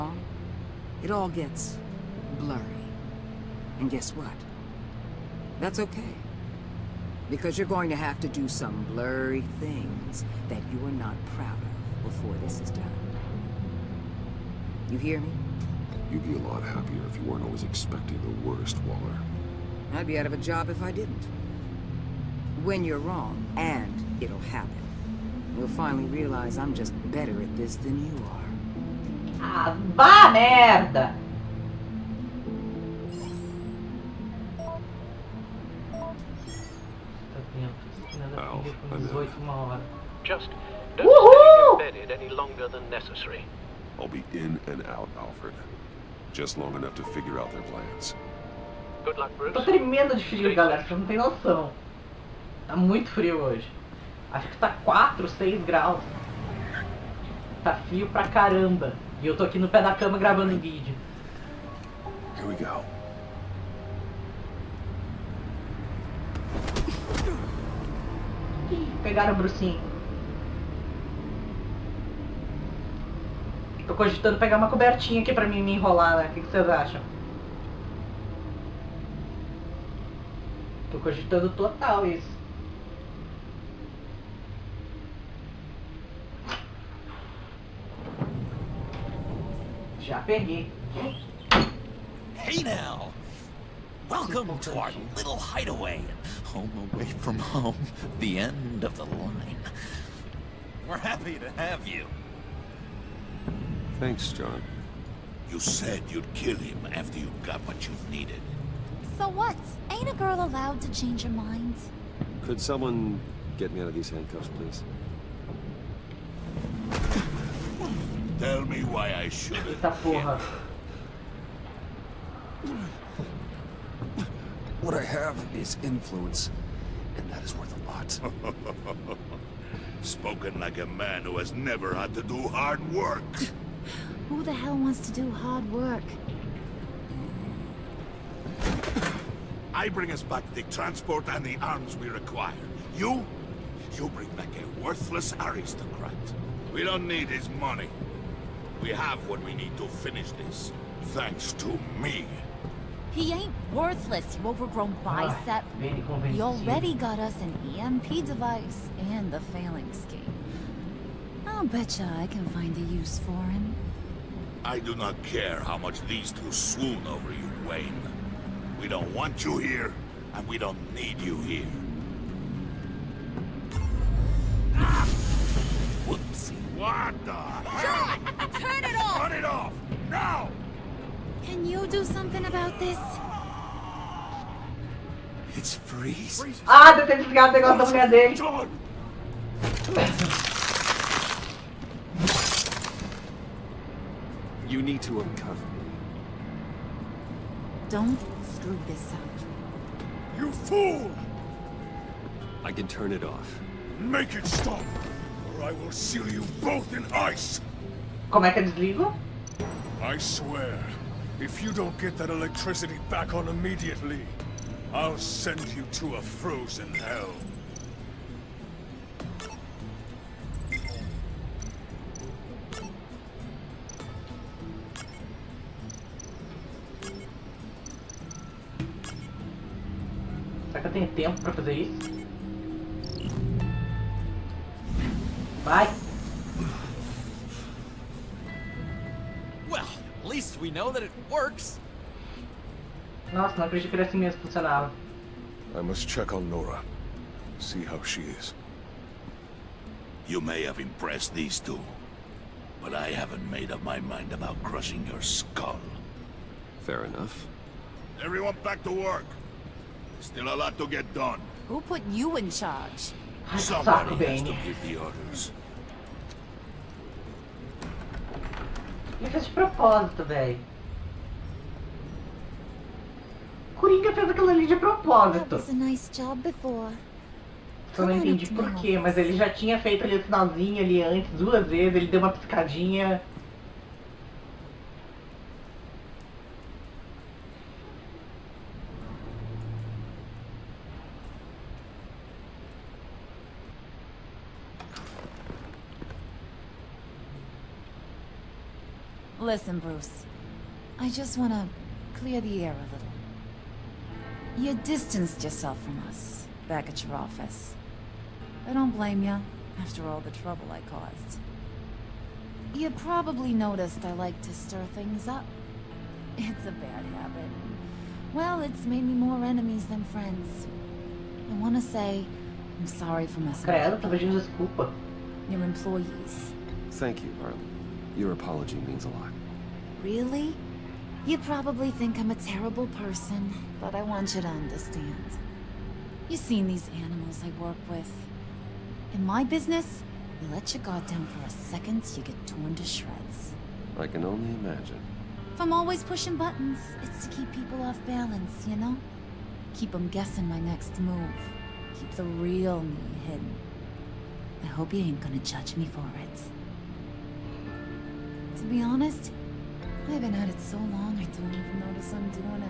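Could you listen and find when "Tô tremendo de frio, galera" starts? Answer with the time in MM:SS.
00:49.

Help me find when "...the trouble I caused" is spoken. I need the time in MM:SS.
05:10.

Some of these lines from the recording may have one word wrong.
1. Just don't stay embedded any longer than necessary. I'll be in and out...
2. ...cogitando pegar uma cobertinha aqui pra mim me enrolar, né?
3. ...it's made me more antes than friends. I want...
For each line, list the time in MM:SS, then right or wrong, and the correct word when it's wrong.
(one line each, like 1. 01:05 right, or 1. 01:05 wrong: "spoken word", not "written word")
1. 00:40 right
2. 01:13 right
3. 05:18 wrong: "enemies", not "antes".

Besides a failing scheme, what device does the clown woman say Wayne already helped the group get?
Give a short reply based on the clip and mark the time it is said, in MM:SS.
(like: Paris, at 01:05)
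EMP device, at 02:37.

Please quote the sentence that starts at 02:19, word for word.
I bring us back the transport and the arms we require.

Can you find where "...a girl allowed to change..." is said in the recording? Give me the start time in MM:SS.
01:50.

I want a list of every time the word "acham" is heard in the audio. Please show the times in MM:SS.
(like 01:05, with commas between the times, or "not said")
01:16.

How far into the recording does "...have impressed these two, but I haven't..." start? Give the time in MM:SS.
04:10.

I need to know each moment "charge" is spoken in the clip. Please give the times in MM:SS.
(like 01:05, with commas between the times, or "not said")
04:22.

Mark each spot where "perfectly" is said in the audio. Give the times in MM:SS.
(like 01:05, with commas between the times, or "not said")
not said.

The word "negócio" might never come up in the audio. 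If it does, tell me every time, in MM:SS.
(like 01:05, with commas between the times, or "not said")
03:07.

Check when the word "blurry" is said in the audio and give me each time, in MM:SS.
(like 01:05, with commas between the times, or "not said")
00:02, 00:08.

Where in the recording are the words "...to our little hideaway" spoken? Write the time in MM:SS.
01:34.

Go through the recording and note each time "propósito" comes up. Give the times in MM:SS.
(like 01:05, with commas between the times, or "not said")
04:29, 04:34.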